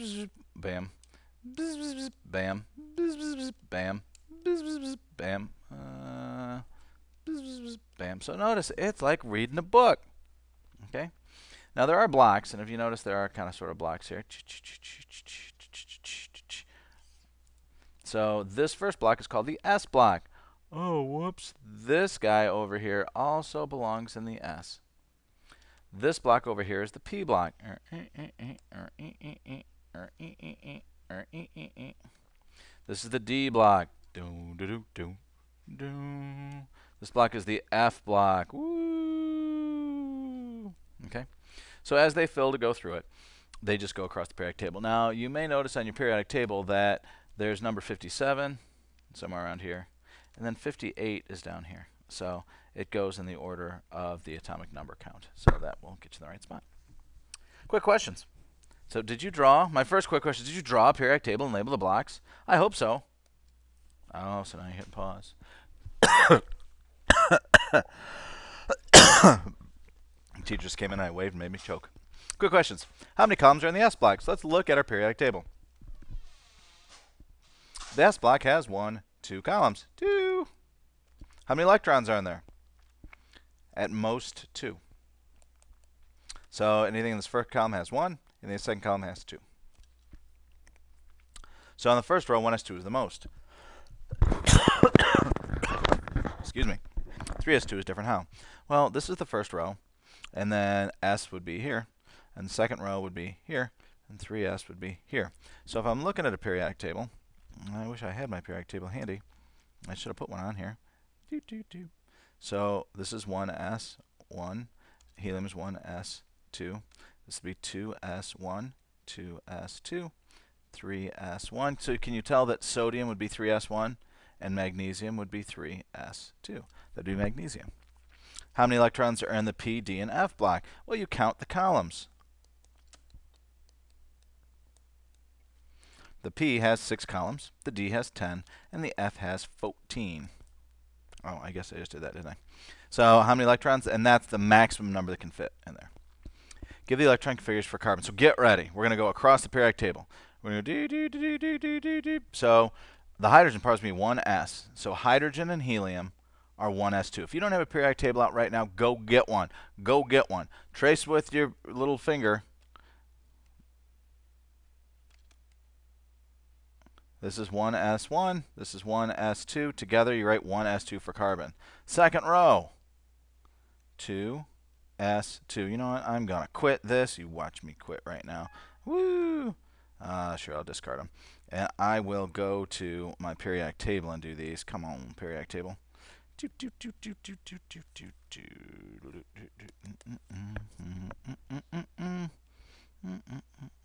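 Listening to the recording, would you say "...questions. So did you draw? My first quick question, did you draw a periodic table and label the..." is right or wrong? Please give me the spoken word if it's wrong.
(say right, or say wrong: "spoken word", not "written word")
right.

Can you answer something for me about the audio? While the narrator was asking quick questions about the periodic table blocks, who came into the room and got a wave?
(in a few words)
Teachers.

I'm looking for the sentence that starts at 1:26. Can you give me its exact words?
So anything in this first column has one and the second column has 2.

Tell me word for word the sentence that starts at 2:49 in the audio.
Together you write 1s2 for carbon.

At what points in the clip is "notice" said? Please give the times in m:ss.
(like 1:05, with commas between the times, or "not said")
0:08, 0:12, 0:45.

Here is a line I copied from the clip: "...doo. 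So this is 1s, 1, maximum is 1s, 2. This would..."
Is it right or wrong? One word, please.
wrong.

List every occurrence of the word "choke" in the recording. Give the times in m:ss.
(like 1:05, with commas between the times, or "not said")
1:11.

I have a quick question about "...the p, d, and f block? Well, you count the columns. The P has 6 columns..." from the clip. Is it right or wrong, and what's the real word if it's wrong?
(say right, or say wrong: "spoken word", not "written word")
right.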